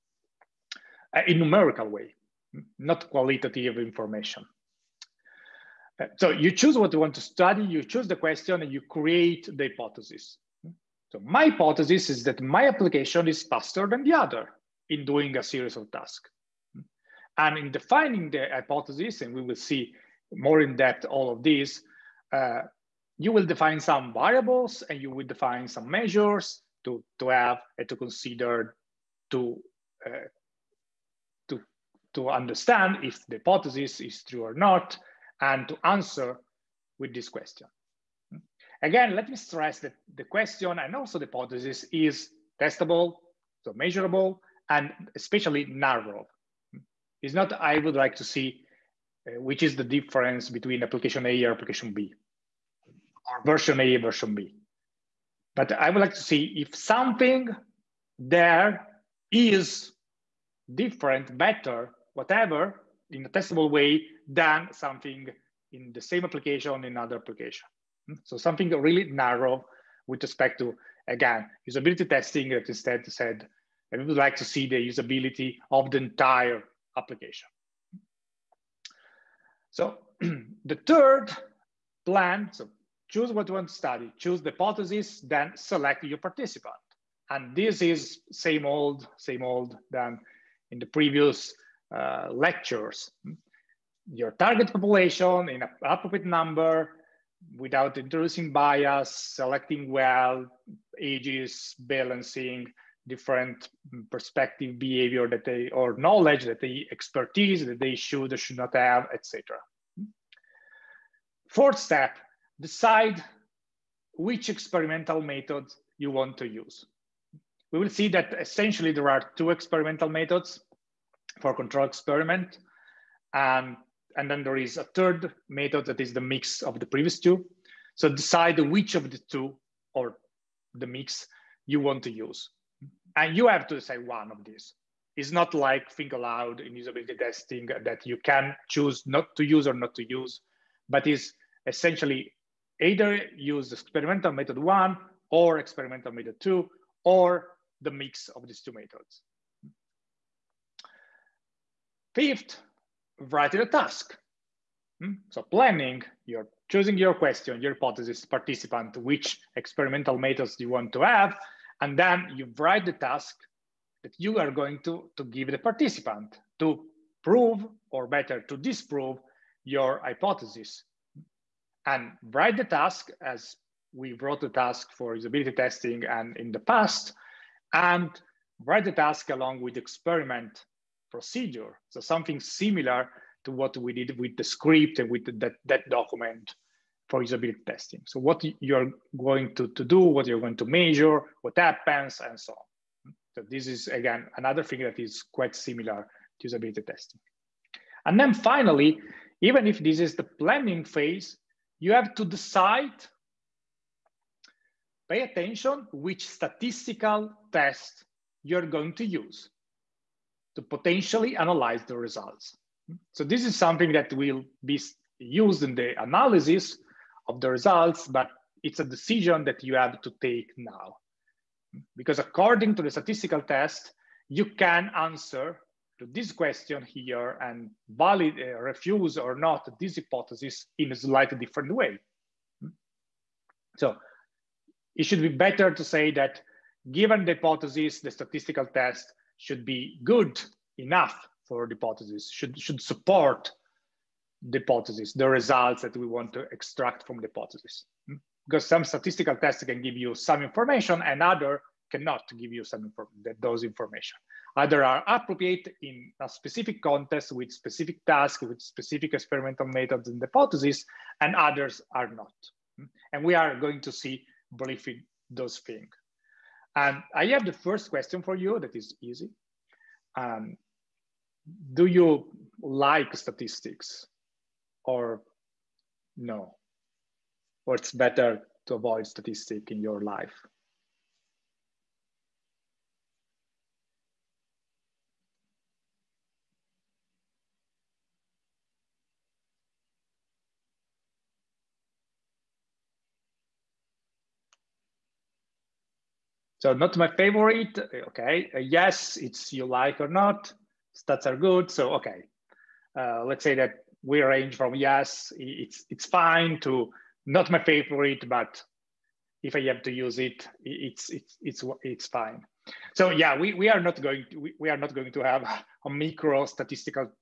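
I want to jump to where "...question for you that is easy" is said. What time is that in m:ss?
4:27.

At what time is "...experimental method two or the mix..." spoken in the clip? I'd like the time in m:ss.
2:25.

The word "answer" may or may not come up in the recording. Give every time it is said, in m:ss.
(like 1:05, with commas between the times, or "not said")
0:35, 3:44.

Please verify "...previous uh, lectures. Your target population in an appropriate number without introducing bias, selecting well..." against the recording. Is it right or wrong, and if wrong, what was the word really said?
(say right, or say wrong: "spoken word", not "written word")
right.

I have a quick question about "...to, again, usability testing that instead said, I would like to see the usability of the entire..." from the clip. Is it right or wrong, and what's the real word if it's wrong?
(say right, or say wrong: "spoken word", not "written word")
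right.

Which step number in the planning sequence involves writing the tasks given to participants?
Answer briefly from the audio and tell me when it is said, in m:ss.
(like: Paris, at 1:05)
Fifth, at 2:32.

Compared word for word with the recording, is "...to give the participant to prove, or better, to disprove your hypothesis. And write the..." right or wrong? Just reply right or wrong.
right.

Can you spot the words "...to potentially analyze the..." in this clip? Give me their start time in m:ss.
3:30.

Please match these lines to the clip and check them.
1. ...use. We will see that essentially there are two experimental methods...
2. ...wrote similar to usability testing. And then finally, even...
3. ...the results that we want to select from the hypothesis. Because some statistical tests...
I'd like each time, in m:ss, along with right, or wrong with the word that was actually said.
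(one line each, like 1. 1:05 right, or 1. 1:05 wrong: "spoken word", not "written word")
1. 1:56 right
2. 3:15 wrong: "quite", not "wrote"
3. 4:05 wrong: "extract", not "select".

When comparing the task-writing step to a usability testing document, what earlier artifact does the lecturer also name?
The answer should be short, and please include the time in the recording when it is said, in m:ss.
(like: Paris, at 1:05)
the script, at 3:04.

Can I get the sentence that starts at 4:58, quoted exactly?
Uh, yes, it's you like or not, stats are good, so okay.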